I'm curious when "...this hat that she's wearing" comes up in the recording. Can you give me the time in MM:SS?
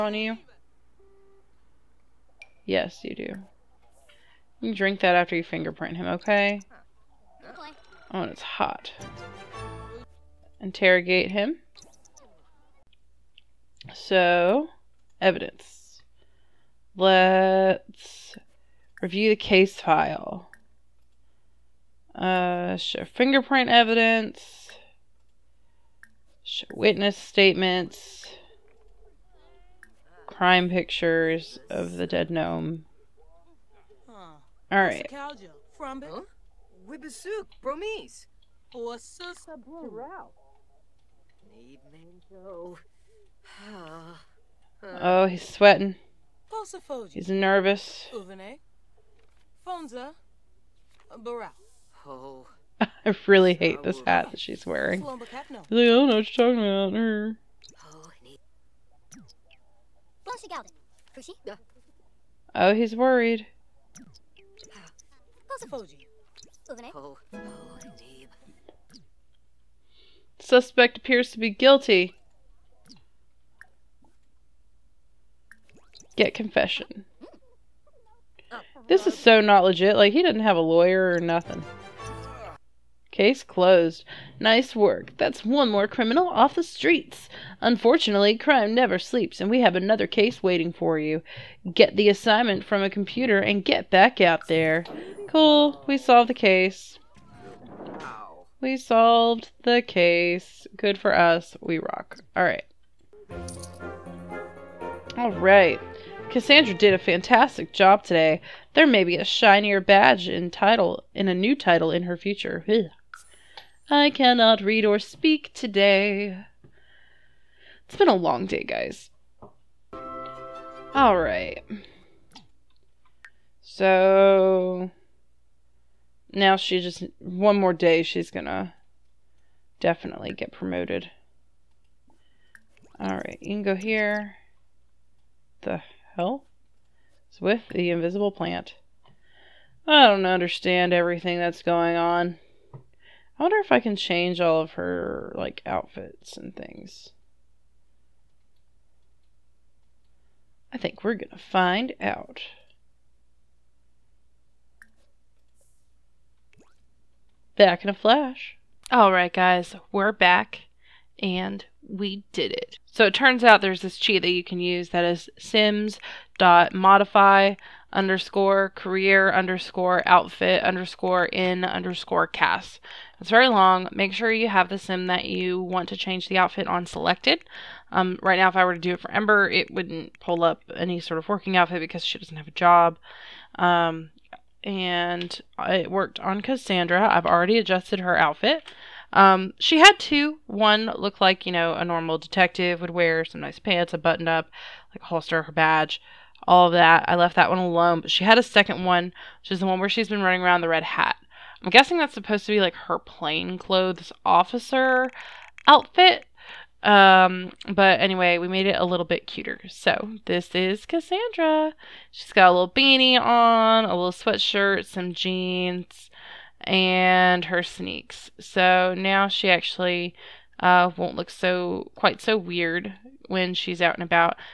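00:53.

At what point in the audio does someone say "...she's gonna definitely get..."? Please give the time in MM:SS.
02:08.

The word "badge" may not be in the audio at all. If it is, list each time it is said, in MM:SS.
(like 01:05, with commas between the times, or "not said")
01:49, 03:15.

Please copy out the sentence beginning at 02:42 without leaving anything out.
So it turns out there's this cheat that you can use that is modify underscore career underscore outfit underscore in underscore cast.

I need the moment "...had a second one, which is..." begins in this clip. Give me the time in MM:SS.
03:18.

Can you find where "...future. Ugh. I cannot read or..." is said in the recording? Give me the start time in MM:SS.
01:52.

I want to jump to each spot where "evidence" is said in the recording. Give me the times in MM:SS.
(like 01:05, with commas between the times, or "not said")
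00:15, 00:23.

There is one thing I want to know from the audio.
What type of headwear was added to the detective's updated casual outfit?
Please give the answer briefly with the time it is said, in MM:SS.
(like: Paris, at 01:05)
Beanie, at 03:32.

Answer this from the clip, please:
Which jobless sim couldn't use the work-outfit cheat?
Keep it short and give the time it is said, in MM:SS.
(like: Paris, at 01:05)
Ember, at 02:59.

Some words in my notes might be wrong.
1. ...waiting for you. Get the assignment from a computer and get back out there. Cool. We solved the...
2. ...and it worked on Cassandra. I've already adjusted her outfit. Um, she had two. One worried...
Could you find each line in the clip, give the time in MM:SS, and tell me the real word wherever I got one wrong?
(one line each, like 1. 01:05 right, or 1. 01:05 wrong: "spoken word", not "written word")
1. 01:30 right
2. 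03:04 wrong: "looked", not "worried".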